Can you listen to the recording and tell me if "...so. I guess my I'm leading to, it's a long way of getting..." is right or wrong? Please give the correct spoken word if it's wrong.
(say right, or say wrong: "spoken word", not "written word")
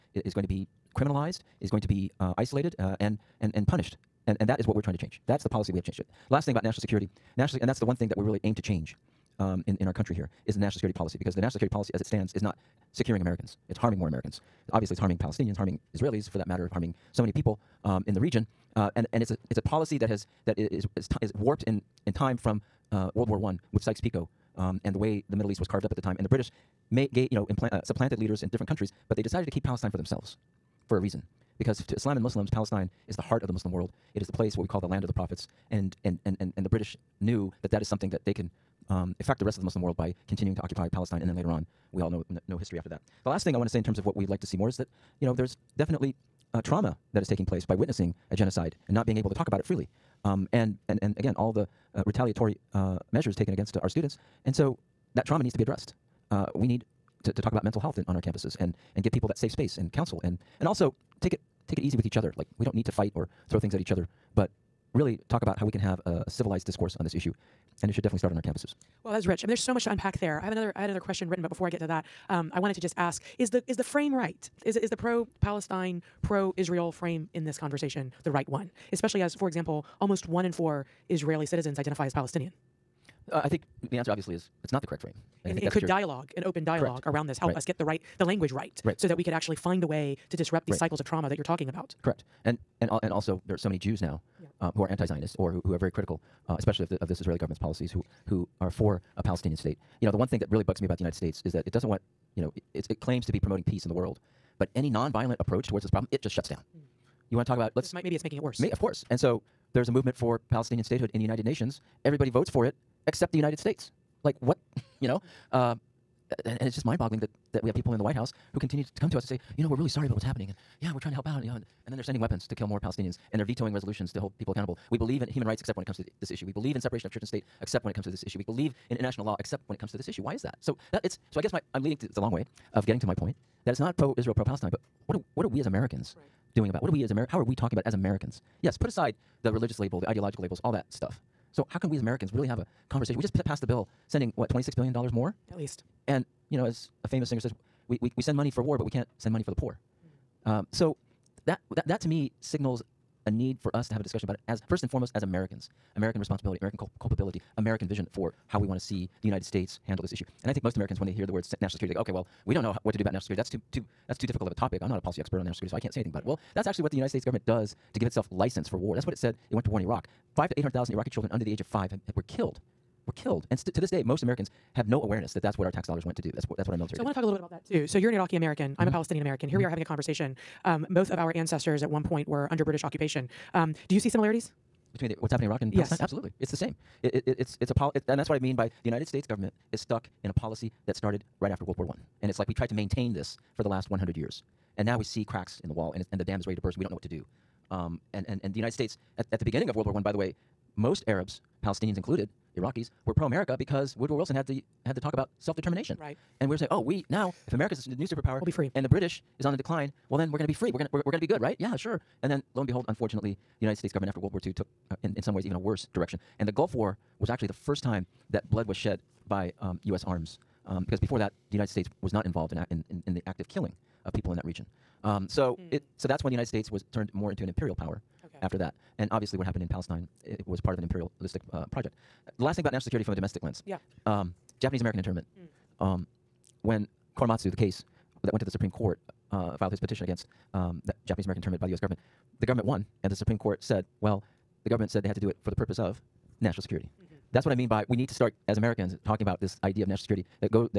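right.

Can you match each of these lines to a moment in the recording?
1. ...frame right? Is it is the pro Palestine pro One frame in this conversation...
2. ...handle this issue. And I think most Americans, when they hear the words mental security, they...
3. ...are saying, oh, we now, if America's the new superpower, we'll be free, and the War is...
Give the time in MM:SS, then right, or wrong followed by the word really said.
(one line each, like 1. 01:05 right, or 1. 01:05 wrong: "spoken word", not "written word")
1. 01:13 wrong: "Israel", not "One"
2. 02:39 wrong: "national", not "mental"
3. 03:26 wrong: "British", not "War".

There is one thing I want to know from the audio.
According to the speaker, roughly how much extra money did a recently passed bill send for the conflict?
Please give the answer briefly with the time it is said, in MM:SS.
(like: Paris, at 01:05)
26 billion dollars, at 02:24.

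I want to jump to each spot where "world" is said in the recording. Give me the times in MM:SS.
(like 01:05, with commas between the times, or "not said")
00:23, 00:33, 00:39, 01:43, 03:11, 03:19, 03:34.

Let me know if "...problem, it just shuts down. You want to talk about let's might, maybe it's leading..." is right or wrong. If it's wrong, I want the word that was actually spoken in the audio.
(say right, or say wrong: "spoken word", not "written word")
wrong: "making", not "leading".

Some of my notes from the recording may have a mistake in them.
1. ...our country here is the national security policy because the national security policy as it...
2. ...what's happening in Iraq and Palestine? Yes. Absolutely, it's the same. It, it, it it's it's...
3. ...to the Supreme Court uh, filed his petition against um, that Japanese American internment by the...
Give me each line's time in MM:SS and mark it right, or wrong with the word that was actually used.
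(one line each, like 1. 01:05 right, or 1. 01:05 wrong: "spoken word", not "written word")
1. 00:09 right
2. 03:05 right
3. 03:58 right.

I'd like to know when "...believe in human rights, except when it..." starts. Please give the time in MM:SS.
02:04.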